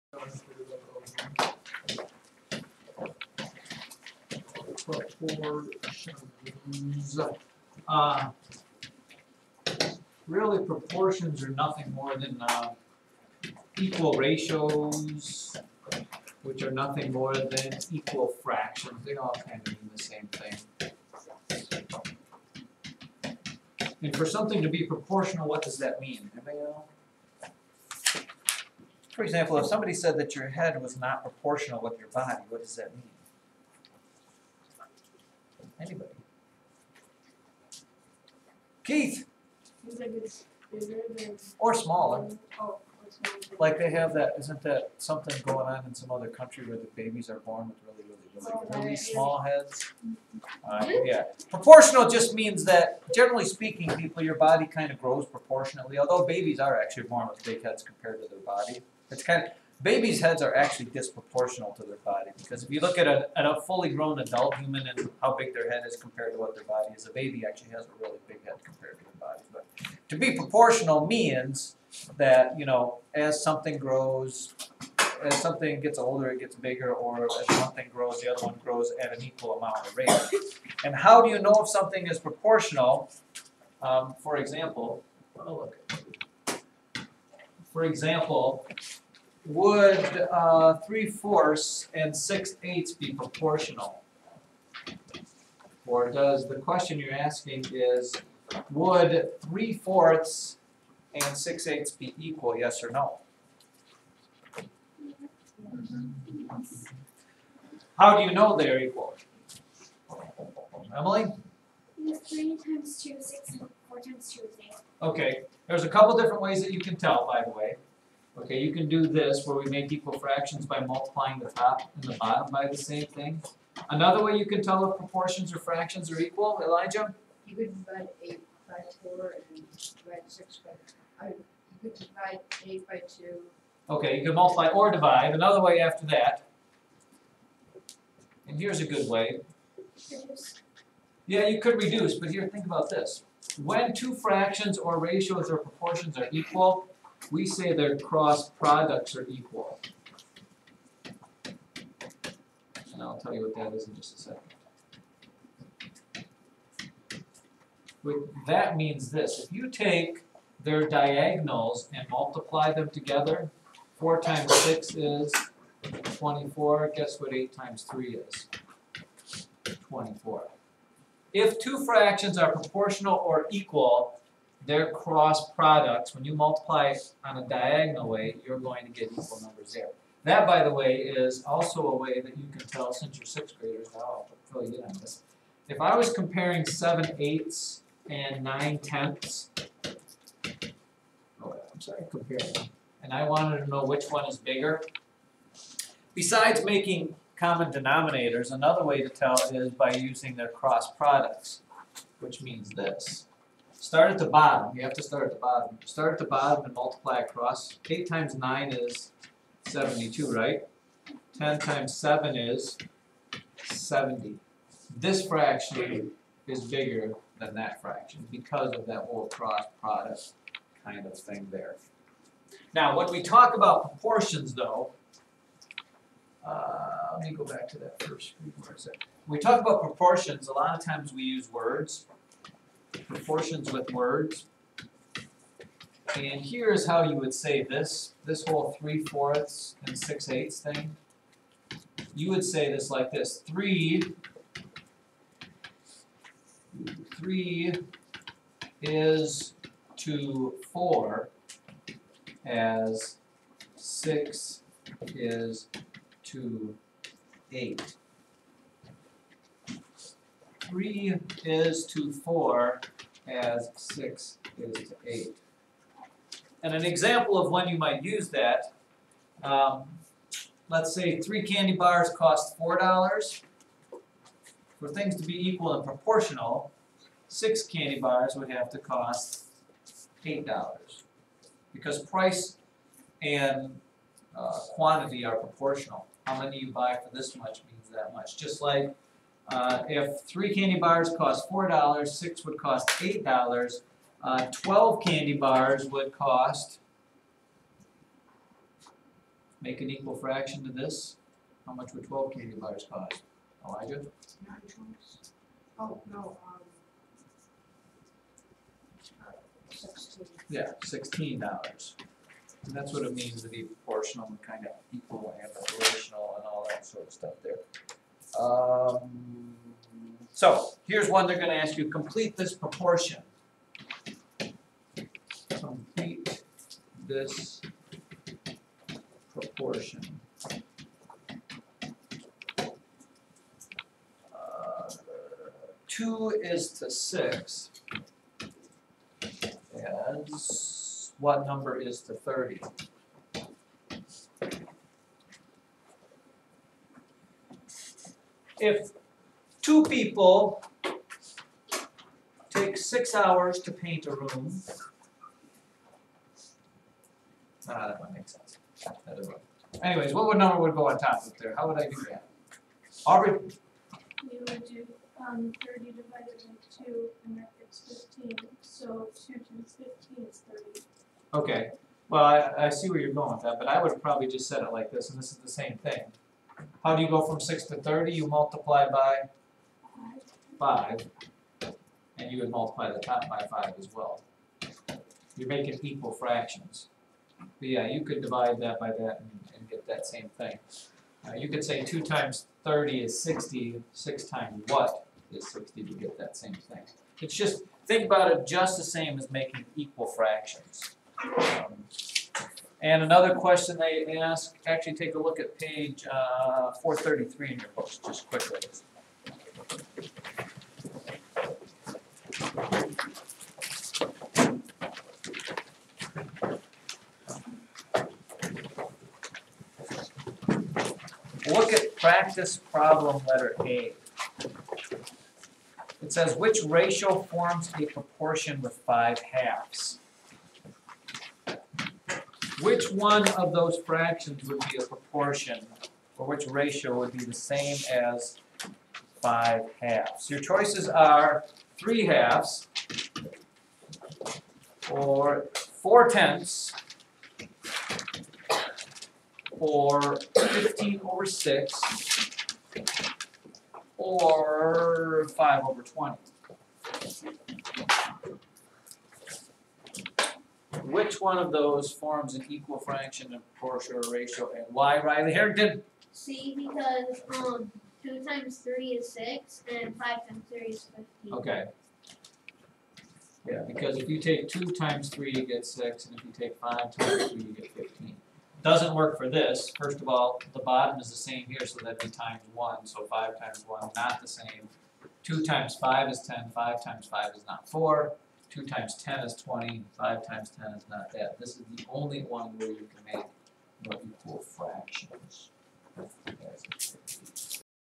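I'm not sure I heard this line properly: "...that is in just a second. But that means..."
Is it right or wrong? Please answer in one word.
right.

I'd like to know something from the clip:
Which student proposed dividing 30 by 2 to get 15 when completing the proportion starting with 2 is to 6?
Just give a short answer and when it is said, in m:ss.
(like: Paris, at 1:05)
Aubrey, at 6:03.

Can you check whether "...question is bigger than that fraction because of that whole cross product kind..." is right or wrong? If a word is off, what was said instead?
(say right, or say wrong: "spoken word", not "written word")
wrong: "fraction", not "question".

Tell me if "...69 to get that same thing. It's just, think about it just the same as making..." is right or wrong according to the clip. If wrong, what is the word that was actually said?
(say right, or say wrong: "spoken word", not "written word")
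wrong: "60", not "69".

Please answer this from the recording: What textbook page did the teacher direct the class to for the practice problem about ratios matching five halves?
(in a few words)
433.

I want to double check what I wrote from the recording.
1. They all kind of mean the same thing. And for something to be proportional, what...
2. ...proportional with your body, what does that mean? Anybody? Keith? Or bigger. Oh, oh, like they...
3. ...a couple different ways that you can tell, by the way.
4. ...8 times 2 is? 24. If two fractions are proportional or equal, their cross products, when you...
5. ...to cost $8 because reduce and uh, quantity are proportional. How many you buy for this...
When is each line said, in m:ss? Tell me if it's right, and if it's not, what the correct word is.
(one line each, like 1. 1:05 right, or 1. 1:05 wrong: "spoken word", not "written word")
1. 0:19 right
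2. 0:31 wrong: "smaller", not "bigger"
3. 1:55 right
4. 2:47 wrong: "3", not "2"
5. 4:38 wrong: "price", not "reduce".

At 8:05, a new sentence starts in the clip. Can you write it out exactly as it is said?
2 times 5 is 10, 5 times 5 is not 4.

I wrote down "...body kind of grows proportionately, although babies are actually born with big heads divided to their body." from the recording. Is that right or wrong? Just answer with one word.
wrong.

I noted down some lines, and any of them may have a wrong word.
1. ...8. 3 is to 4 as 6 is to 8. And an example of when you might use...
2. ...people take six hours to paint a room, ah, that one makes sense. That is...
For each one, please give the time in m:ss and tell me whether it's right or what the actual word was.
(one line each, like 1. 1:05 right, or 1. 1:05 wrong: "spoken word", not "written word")
1. 4:17 right
2. 5:49 right.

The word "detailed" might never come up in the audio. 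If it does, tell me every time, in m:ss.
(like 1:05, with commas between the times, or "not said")
not said.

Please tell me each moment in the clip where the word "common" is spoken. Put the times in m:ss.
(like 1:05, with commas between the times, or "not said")
3:17.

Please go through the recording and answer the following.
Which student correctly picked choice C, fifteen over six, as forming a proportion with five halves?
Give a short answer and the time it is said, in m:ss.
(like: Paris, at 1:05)
Riley Harrington, at 7:45.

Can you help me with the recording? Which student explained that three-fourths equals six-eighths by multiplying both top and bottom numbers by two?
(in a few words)
Emily.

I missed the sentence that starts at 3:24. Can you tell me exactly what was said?
You have to start at the bottom.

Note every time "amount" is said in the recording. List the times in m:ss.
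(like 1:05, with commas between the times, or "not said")
1:19.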